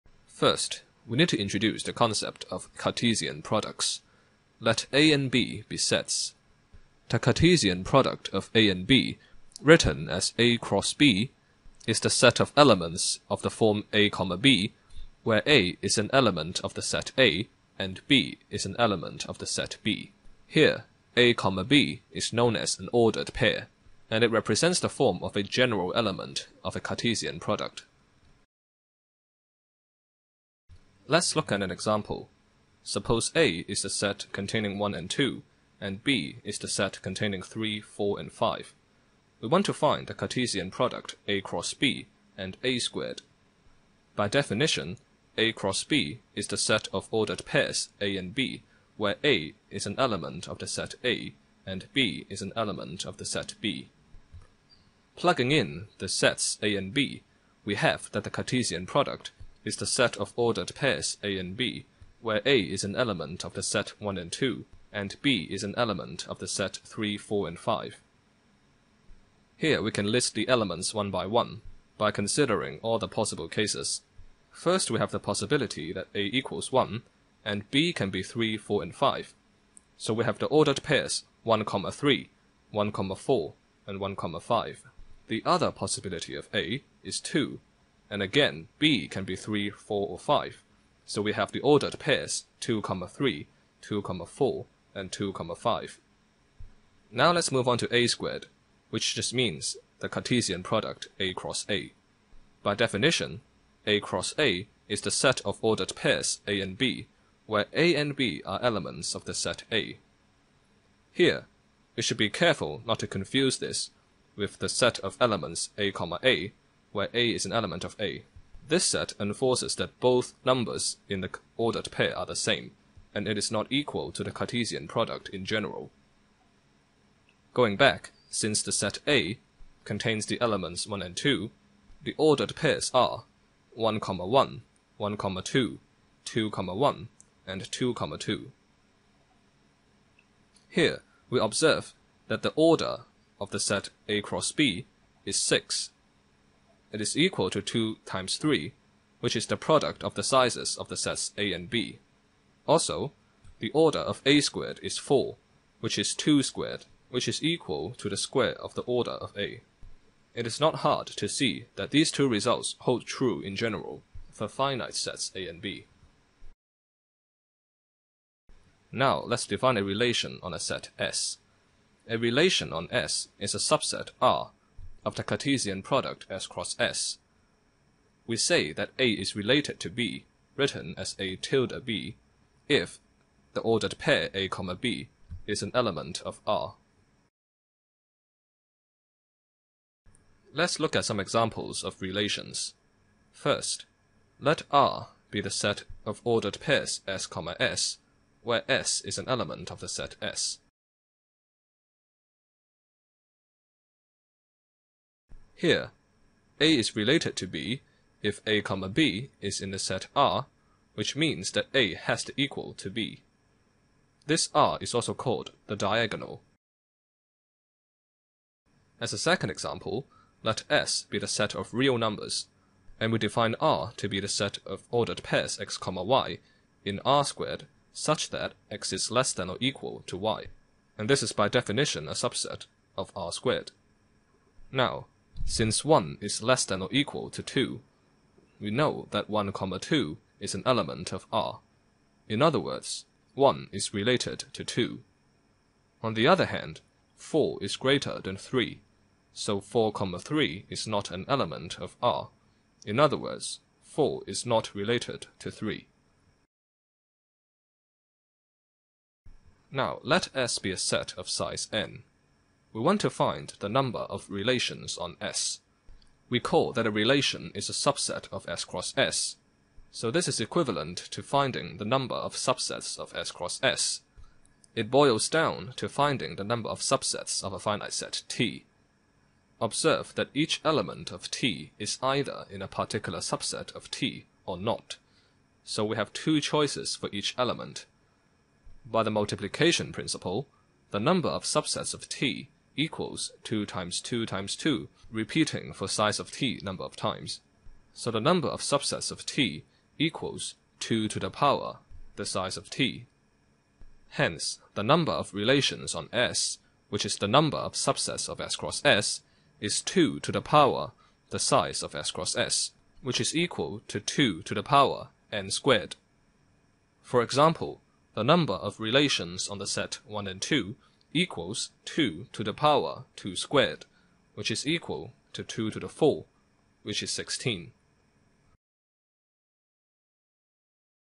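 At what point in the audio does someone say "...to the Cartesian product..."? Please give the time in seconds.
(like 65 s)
124 s.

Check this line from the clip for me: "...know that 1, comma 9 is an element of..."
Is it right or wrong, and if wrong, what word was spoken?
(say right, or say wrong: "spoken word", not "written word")
wrong: "2", not "9".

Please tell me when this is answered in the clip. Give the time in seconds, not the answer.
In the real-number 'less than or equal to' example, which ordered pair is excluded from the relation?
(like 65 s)
249 s.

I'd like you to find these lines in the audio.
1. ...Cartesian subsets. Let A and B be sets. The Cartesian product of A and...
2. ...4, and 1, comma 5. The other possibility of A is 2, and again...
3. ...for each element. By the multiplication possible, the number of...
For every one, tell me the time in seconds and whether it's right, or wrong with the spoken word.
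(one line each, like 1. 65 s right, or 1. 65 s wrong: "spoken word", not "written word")
1. 2 s wrong: "products", not "subsets"
2. 83 s right
3. 286 s wrong: "principle", not "possible".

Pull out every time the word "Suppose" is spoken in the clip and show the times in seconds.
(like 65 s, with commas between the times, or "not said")
32 s.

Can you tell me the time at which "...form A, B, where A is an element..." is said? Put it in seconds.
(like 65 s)
13 s.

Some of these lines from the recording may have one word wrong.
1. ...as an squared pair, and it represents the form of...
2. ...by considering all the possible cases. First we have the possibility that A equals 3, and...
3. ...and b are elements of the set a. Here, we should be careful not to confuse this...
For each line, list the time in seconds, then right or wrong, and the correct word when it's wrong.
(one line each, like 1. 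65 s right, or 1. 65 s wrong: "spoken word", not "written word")
1. 22 s wrong: "ordered", not "squared"
2. 71 s wrong: "1", not "3"
3. 107 s right.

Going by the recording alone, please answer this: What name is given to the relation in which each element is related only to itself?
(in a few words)
the diagonal.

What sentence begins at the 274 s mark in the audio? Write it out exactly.
It boils down to finding the number of subsets of a finite set T.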